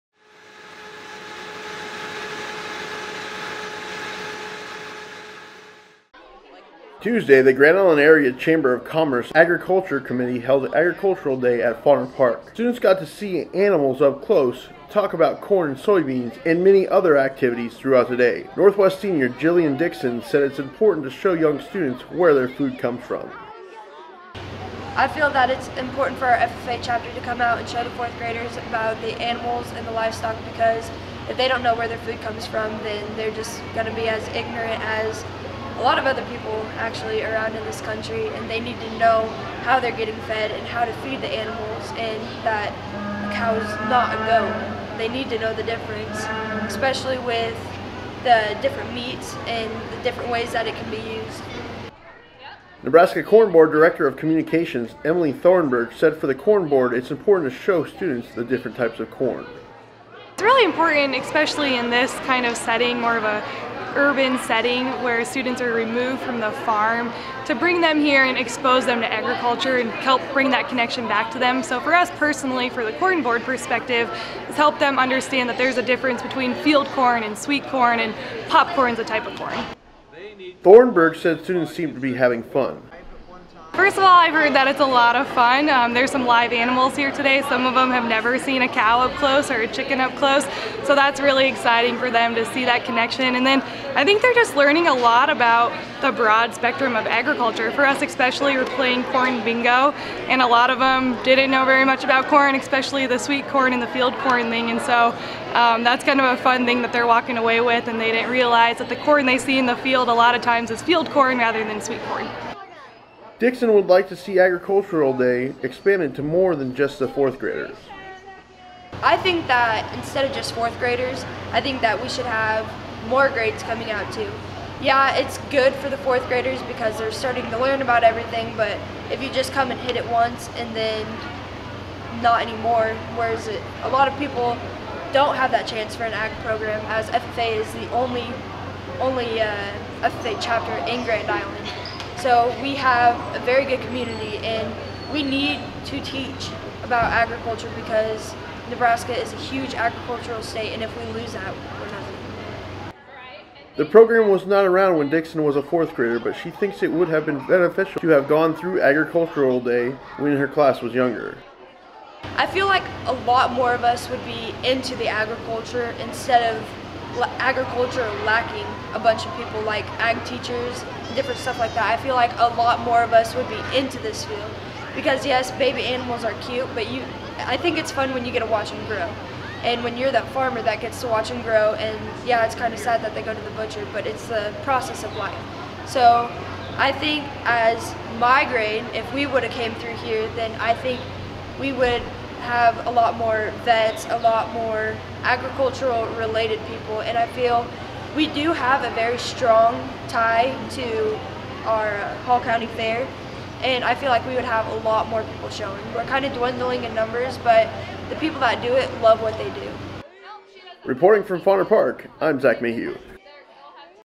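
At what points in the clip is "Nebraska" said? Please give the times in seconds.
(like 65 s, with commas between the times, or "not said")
52 s, 148 s.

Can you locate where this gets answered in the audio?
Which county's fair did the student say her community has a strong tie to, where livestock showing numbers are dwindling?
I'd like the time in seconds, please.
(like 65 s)
202 s.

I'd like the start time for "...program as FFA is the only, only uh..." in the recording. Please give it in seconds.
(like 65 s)
136 s.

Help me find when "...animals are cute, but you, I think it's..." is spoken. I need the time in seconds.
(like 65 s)
175 s.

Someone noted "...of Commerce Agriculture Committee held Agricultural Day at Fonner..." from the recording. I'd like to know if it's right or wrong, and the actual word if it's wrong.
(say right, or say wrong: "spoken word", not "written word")
right.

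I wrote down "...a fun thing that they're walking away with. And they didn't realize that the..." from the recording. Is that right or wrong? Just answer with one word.
right.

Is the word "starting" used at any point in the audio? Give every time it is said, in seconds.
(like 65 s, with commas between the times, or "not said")
127 s.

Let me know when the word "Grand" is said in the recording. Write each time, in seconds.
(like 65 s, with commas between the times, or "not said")
7 s, 141 s.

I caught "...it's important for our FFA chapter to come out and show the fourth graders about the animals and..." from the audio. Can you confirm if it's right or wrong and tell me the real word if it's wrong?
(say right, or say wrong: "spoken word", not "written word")
right.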